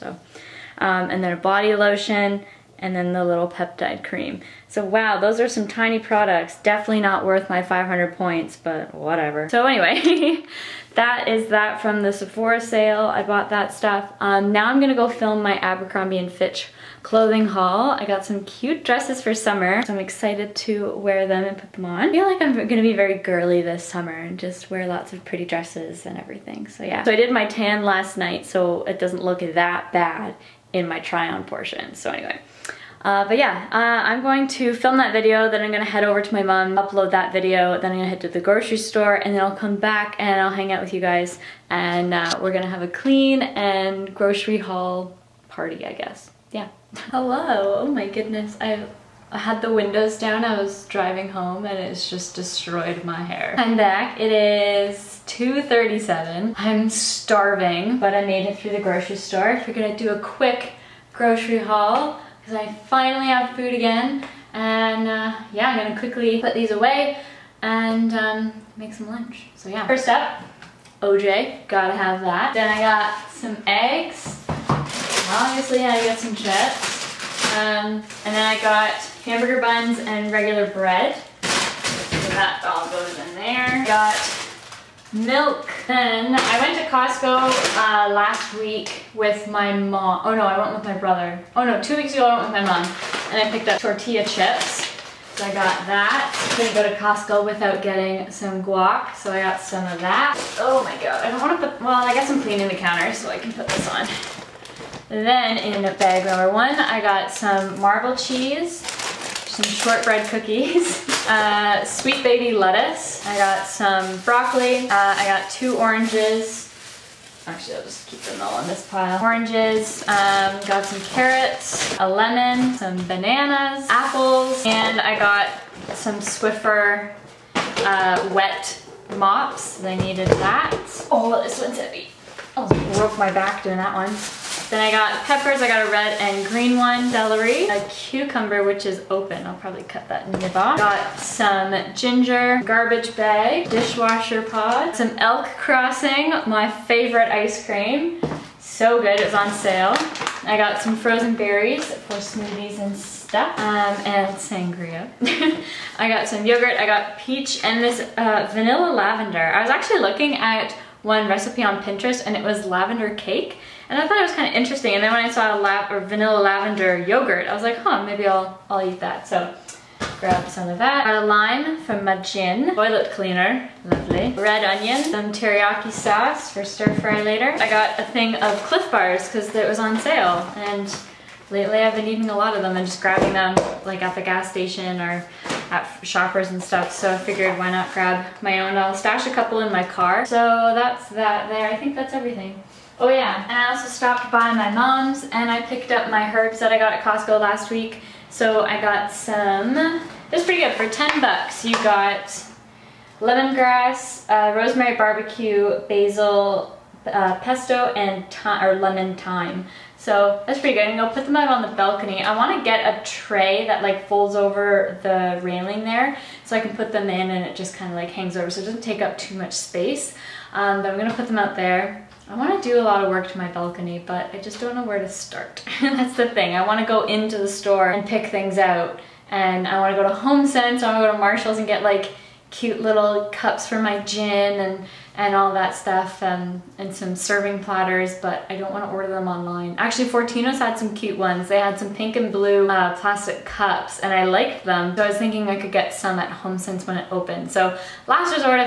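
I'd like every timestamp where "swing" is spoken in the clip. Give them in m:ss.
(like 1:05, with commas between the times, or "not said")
not said.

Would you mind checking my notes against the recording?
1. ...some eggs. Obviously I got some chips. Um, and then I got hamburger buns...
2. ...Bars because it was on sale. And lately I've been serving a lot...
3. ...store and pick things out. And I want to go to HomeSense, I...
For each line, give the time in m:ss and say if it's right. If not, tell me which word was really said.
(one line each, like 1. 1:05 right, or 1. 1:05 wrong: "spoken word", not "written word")
1. 1:13 right
2. 2:58 wrong: "eating", not "serving"
3. 3:47 right.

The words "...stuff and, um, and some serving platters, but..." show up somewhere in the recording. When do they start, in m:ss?
3:55.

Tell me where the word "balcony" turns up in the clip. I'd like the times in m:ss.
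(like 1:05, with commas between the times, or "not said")
3:31, 3:43.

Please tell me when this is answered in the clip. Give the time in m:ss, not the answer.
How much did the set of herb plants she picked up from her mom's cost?
3:20.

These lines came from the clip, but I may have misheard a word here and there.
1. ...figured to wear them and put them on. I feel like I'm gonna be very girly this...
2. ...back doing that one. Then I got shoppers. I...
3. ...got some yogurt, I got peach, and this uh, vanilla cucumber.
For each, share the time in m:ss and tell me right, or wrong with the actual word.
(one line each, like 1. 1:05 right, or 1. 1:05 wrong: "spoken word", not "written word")
1. 0:19 wrong: "excited", not "figured"
2. 2:13 wrong: "peppers", not "shoppers"
3. 2:36 wrong: "lavender", not "cucumber".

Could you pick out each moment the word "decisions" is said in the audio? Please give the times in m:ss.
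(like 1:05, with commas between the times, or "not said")
not said.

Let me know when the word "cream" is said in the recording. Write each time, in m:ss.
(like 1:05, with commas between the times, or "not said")
0:04, 2:27.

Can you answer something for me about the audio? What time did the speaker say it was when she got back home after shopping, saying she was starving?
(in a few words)
2:37.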